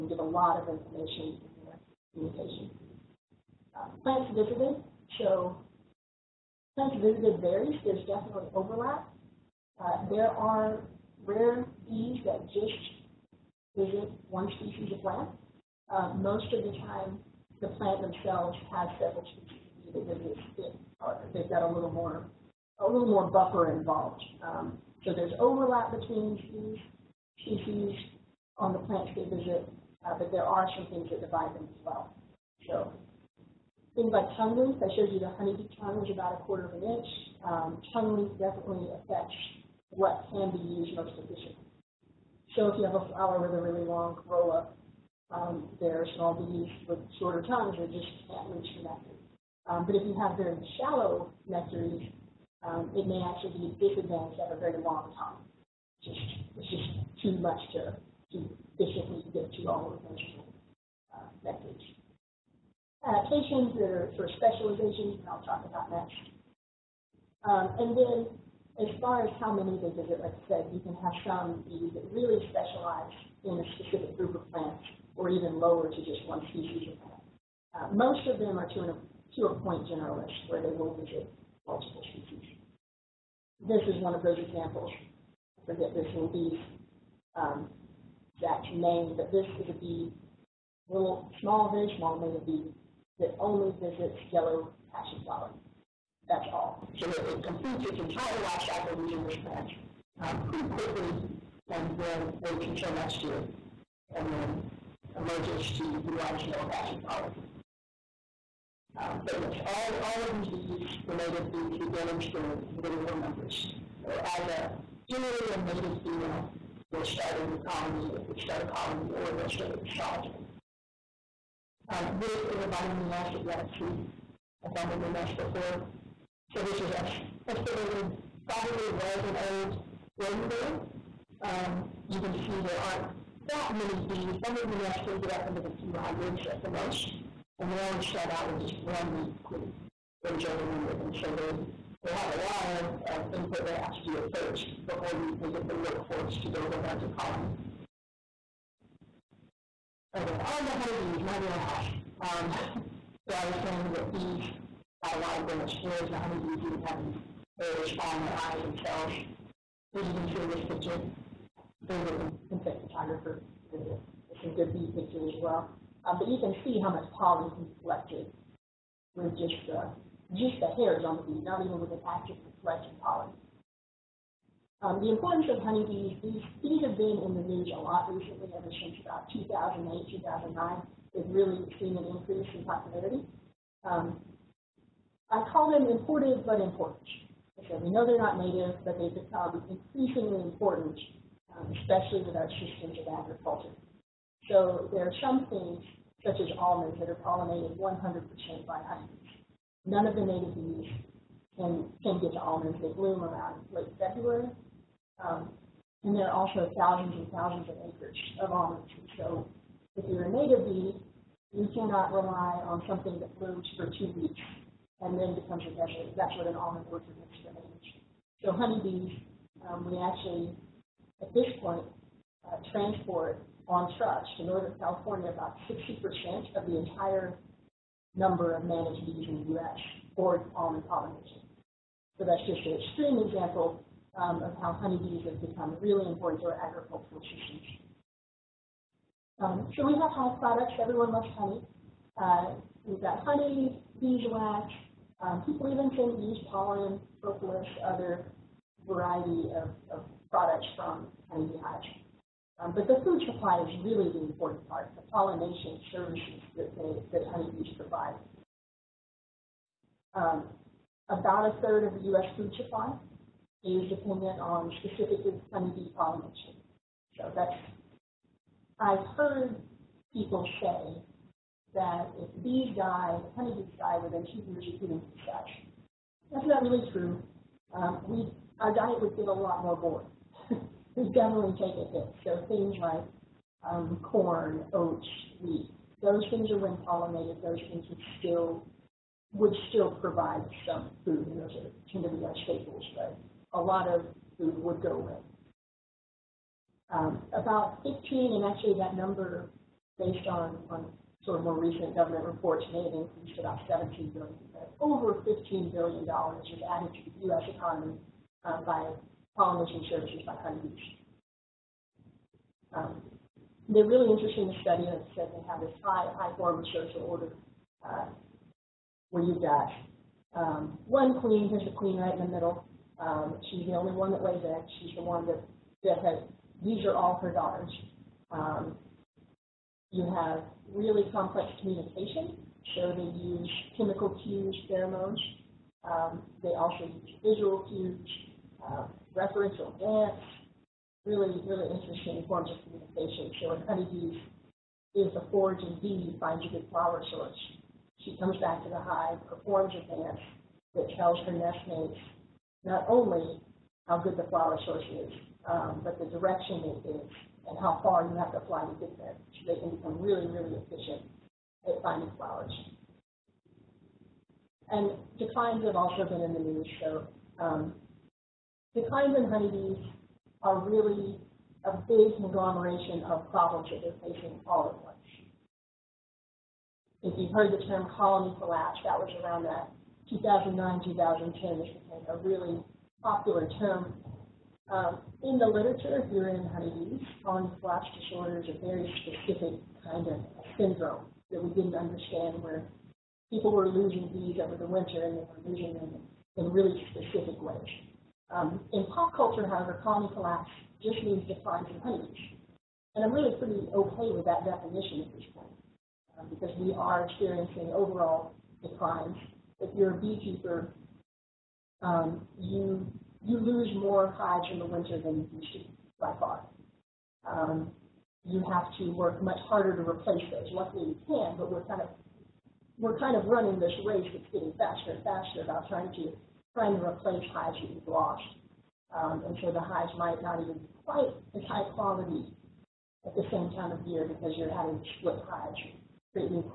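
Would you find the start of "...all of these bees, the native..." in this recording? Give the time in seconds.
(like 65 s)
110 s.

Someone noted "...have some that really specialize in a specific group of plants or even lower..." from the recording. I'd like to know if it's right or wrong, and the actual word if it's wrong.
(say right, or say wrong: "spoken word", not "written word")
right.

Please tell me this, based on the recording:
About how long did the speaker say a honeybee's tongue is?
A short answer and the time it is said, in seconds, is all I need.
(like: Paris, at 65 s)
a quarter of an inch, at 36 s.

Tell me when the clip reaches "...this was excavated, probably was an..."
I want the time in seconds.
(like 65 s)
126 s.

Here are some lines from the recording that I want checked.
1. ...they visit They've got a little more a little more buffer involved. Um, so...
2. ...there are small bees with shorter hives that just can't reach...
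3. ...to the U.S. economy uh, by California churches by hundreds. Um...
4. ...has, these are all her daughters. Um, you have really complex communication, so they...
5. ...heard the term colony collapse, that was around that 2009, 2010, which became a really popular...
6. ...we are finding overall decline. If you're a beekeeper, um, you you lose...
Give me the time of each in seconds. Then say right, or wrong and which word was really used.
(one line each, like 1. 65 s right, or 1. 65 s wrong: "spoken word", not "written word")
1. 20 s right
2. 45 s wrong: "tongues", not "hives"
3. 306 s wrong: "Polynesian", not "California"
4. 326 s right
5. 377 s right
6. 406 s wrong: "experiencing", not "finding".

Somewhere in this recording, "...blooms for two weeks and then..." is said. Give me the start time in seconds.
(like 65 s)
213 s.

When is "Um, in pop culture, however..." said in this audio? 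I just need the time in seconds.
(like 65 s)
398 s.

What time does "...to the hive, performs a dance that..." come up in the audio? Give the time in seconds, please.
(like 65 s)
348 s.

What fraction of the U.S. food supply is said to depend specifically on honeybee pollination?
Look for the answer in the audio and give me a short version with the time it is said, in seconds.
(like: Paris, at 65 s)
a third, at 261 s.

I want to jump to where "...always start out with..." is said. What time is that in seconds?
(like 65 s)
137 s.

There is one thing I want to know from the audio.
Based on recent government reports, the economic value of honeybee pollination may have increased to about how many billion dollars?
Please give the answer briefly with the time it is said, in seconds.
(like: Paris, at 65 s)
17 billion, at 303 s.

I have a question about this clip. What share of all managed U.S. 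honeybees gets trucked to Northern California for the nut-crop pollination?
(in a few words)
60%.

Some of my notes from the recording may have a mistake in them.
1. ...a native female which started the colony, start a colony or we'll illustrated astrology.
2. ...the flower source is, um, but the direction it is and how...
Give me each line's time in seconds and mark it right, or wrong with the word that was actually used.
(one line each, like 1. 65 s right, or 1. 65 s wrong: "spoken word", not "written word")
1. 115 s right
2. 354 s right.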